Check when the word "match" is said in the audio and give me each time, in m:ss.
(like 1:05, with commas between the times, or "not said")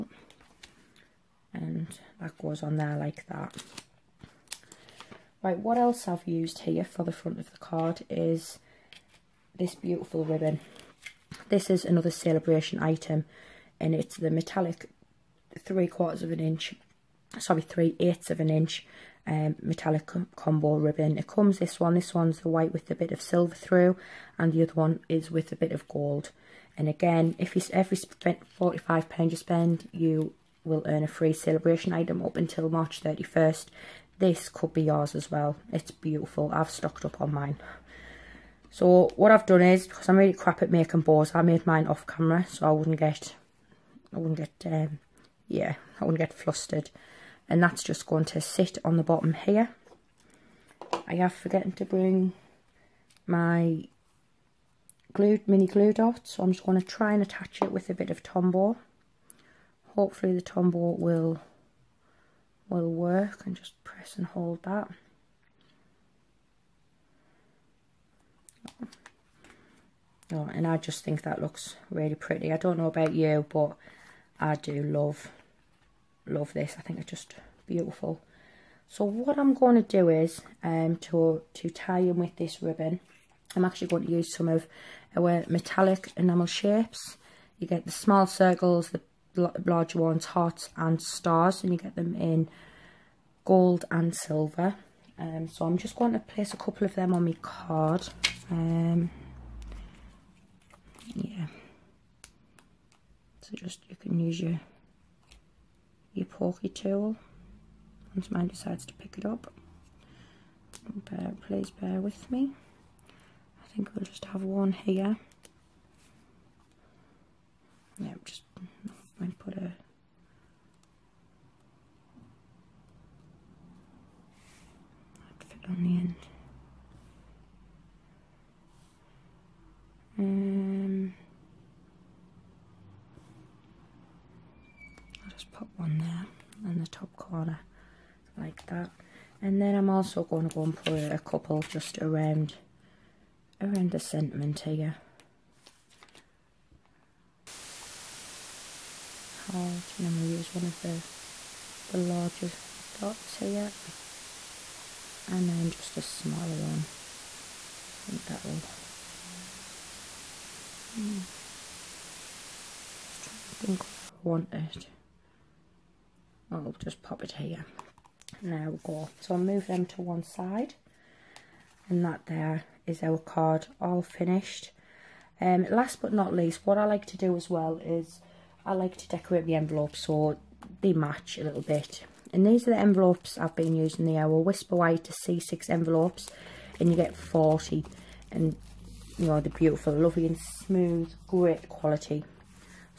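3:00.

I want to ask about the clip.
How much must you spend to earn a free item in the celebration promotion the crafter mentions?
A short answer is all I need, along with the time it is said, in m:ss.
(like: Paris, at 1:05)
£45, at 0:27.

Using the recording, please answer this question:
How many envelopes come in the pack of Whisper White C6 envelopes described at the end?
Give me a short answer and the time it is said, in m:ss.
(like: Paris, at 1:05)
40, at 3:07.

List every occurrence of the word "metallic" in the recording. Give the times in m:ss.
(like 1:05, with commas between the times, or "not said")
0:14, 0:19, 1:25.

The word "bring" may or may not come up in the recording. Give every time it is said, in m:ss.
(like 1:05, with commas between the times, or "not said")
0:51.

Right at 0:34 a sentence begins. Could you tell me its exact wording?
This could be yours as well.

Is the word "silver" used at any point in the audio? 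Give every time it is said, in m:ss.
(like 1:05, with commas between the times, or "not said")
0:23, 1:34.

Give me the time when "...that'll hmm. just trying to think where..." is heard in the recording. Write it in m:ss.
2:38.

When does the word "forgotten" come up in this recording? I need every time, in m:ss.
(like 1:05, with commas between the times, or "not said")
0:51.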